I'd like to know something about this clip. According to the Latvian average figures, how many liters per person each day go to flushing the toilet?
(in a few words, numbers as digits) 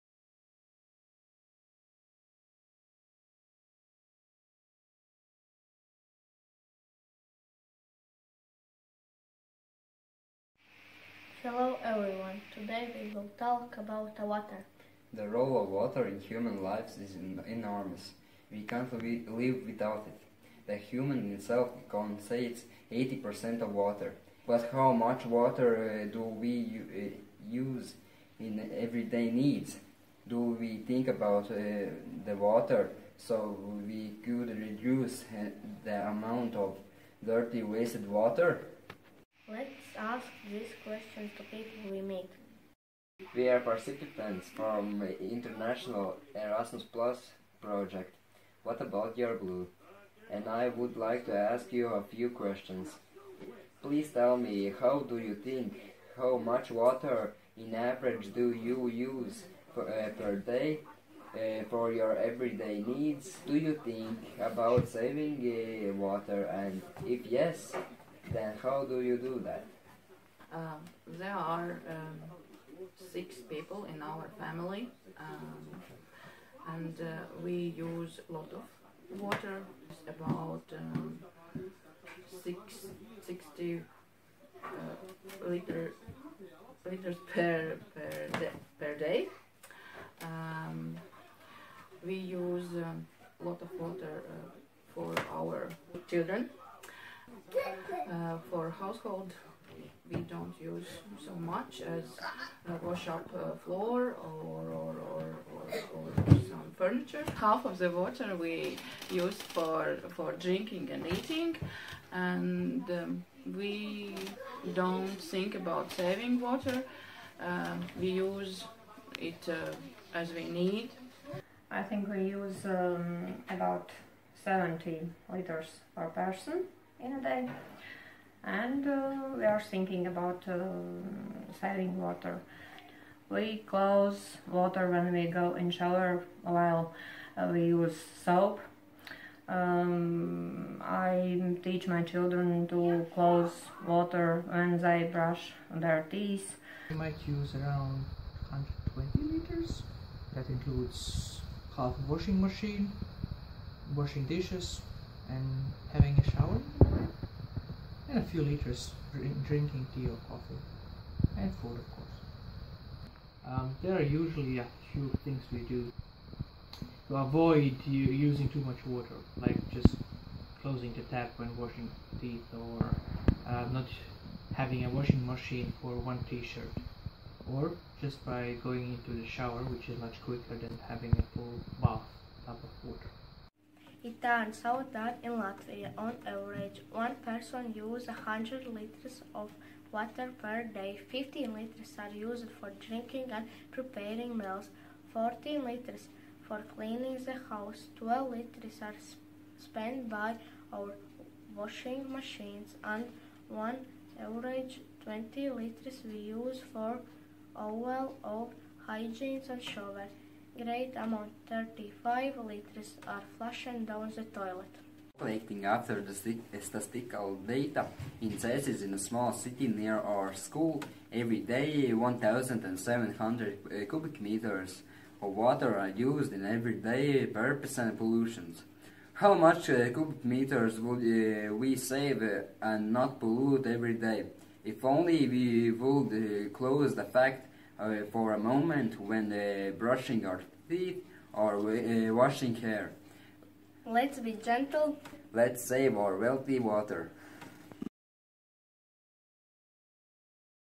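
35 liters.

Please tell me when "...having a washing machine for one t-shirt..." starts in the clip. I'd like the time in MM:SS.
02:54.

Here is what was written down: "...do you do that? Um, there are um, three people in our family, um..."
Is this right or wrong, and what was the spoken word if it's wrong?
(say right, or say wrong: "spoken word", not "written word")
wrong: "six", not "three".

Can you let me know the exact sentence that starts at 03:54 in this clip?
If only we would uh, close the fact uh, for a moment when uh, brushing our teeth or uh, washing hair.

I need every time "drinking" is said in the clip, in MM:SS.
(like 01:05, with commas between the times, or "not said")
01:50, 02:39, 03:12.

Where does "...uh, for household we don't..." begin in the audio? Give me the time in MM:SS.
01:38.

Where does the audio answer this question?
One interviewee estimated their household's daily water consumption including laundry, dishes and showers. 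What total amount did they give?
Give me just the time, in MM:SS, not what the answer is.
02:28.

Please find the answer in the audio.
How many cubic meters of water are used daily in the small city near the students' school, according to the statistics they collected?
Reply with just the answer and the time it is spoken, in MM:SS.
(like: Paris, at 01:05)
1,700, at 03:41.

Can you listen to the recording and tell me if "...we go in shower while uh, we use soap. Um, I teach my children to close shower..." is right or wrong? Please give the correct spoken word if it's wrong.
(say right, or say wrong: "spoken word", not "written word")
wrong: "water", not "shower".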